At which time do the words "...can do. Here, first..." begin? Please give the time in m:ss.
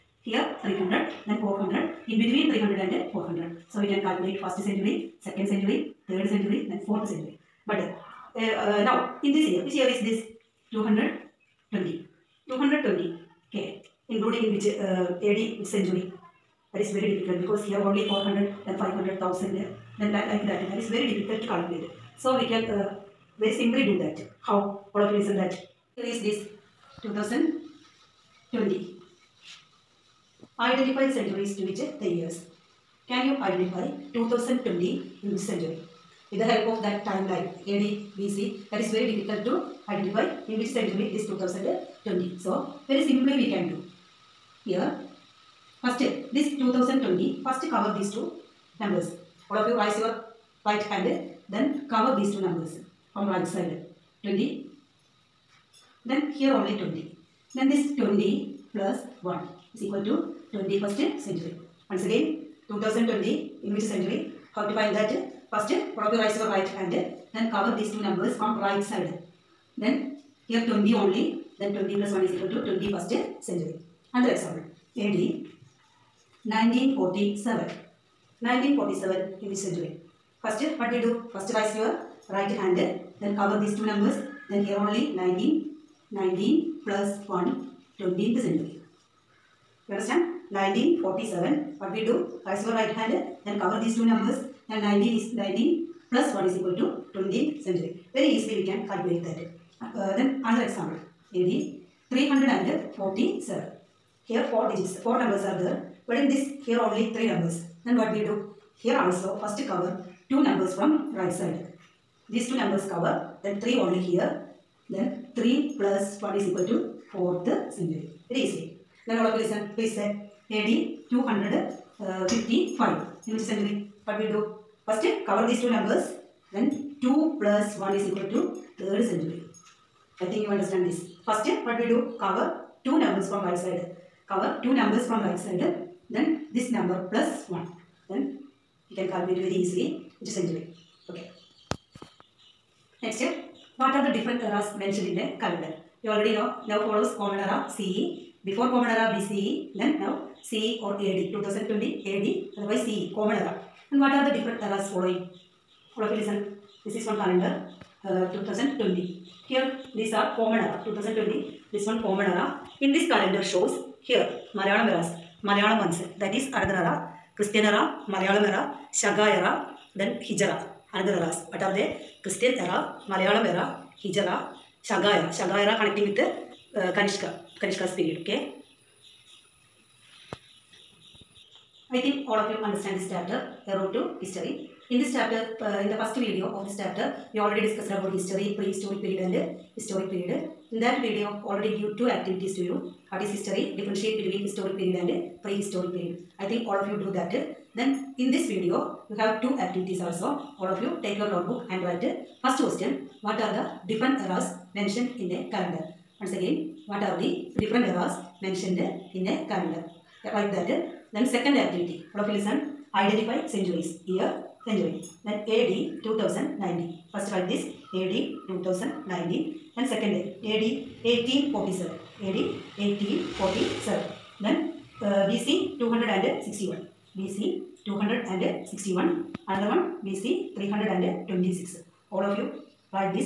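0:43.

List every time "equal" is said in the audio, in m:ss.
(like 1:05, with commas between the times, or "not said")
0:59, 1:12, 1:36, 1:56, 2:08.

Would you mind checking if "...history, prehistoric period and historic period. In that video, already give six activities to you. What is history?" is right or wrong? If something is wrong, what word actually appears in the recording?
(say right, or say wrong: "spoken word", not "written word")
wrong: "two", not "six".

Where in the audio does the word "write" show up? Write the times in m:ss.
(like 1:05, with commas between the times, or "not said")
3:21, 3:30, 3:37.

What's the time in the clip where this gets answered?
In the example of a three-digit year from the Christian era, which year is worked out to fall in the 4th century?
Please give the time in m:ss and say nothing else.
1:41.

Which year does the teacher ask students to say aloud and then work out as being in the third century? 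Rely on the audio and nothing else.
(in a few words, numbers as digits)
AD 255.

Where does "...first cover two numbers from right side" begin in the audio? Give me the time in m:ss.
1:49.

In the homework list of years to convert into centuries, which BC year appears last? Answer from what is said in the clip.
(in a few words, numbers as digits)
BC 326.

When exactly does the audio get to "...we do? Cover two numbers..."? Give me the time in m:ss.
2:11.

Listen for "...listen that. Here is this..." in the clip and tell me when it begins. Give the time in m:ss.
0:25.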